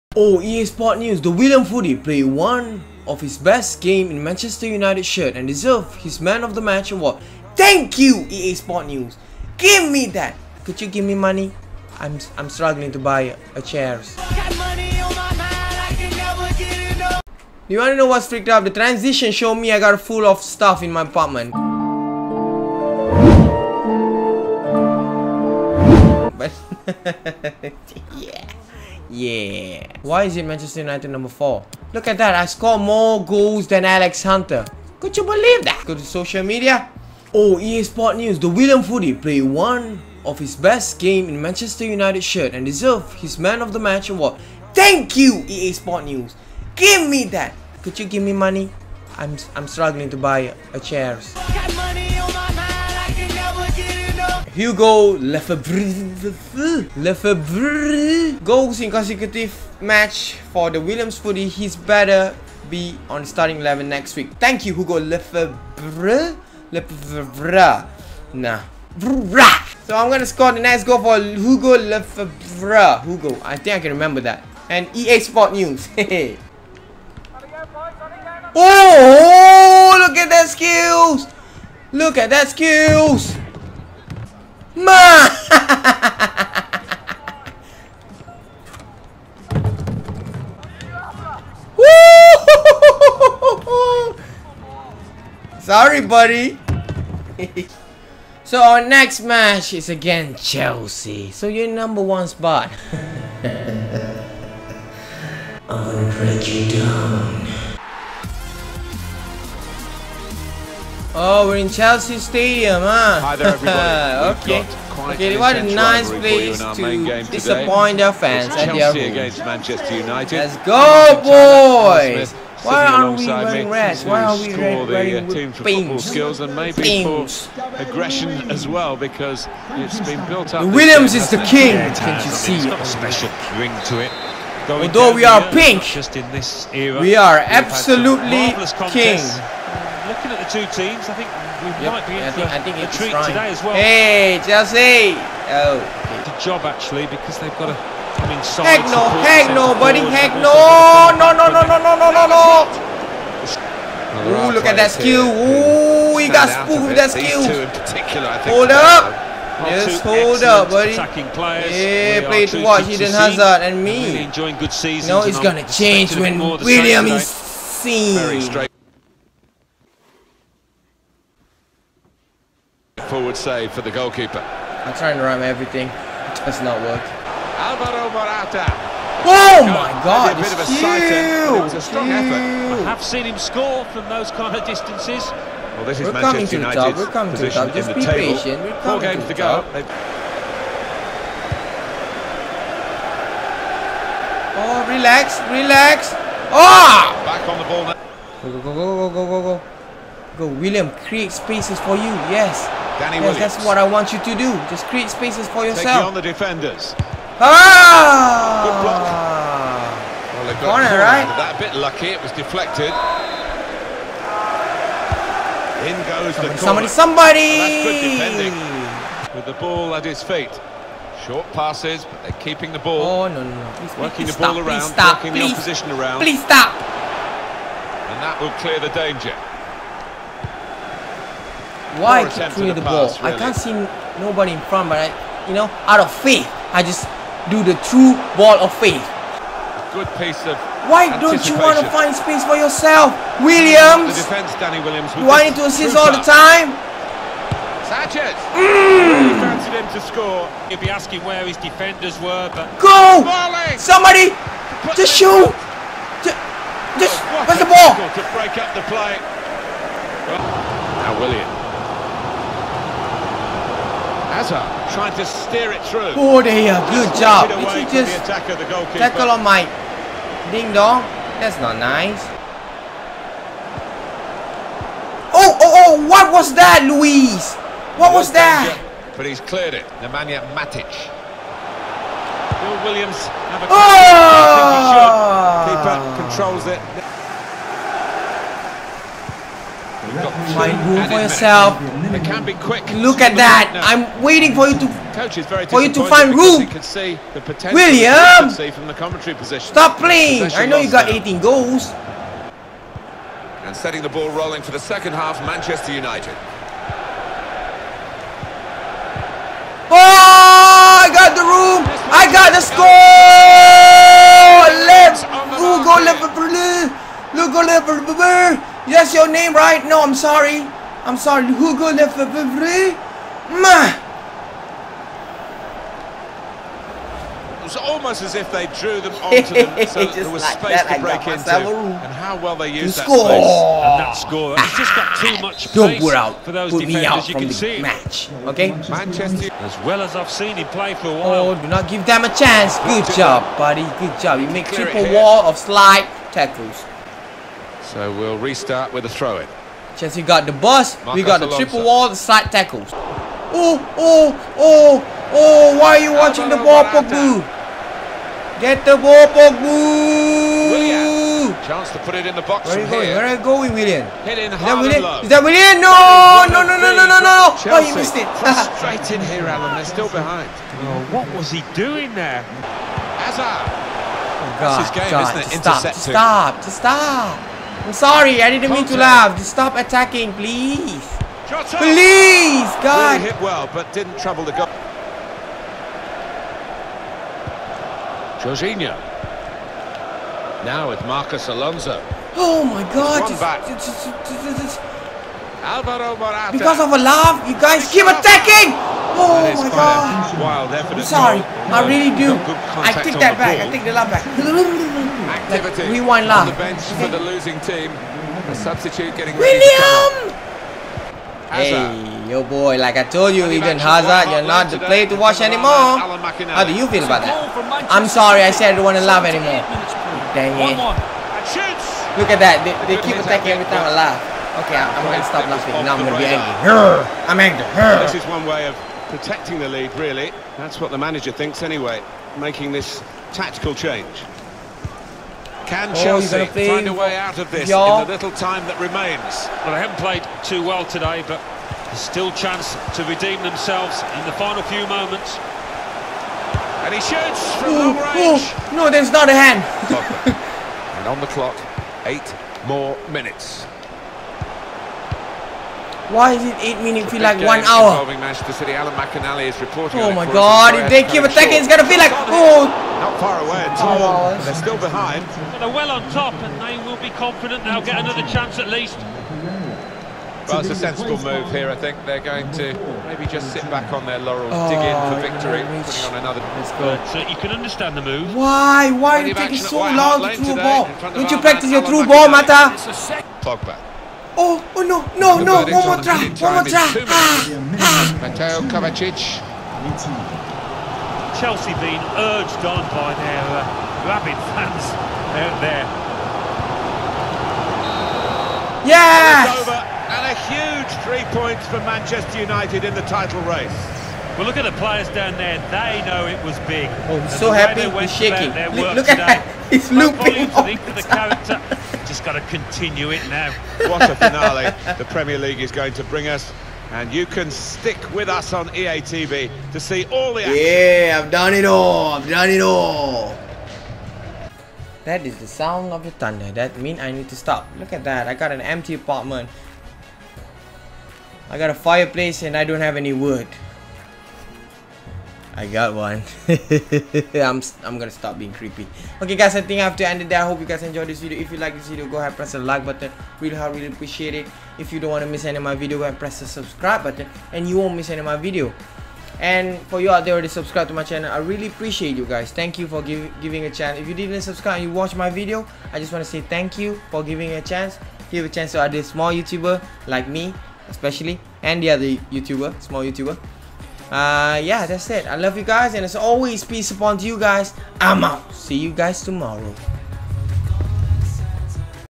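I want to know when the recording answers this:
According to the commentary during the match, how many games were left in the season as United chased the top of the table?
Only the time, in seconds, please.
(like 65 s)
188 s.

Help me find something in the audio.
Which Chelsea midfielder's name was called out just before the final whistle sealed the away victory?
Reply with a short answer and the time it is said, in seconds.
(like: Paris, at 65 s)
Mateo Kovacic, at 488 s.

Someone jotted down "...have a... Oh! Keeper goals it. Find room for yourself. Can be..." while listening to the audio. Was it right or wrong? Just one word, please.
wrong.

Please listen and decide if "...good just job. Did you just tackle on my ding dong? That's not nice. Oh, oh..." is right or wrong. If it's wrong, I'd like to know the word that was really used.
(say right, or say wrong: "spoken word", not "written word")
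right.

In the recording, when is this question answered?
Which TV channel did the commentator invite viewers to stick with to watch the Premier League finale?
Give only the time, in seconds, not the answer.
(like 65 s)
518 s.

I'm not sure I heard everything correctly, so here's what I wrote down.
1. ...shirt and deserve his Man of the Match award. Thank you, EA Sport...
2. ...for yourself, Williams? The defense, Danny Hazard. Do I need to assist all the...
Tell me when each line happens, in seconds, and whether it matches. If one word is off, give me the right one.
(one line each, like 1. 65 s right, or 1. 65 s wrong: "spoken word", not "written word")
1. 42 s right
2. 242 s wrong: "Williams", not "Hazard".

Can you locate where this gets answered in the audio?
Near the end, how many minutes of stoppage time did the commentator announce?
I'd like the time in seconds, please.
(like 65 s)
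452 s.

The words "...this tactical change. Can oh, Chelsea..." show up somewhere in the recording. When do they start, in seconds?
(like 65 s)
432 s.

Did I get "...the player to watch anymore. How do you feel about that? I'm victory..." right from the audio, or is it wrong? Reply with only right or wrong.
wrong.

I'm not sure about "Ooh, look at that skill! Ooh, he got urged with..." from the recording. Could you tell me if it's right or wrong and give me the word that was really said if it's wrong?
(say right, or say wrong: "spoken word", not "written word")
wrong: "spooked", not "urged".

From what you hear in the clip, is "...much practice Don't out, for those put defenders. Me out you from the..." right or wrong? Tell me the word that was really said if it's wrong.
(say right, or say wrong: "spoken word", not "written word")
wrong: "space", not "practice".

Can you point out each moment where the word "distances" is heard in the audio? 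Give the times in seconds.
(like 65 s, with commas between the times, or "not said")
184 s.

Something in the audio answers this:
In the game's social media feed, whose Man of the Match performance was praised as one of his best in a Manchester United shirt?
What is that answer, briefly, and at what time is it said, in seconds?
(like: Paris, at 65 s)
William Foodie, at 1 s.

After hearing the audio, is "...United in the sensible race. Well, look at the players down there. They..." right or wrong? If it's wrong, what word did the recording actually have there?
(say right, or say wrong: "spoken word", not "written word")
wrong: "title", not "sensible".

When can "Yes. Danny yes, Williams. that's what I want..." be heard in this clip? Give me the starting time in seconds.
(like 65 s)
202 s.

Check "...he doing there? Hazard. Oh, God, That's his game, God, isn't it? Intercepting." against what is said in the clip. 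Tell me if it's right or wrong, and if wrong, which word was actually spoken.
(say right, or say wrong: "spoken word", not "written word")
right.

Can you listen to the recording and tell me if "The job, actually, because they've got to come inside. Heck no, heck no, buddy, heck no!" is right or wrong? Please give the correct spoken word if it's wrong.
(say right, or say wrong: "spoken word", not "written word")
right.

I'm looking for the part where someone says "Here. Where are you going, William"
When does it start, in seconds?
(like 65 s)
363 s.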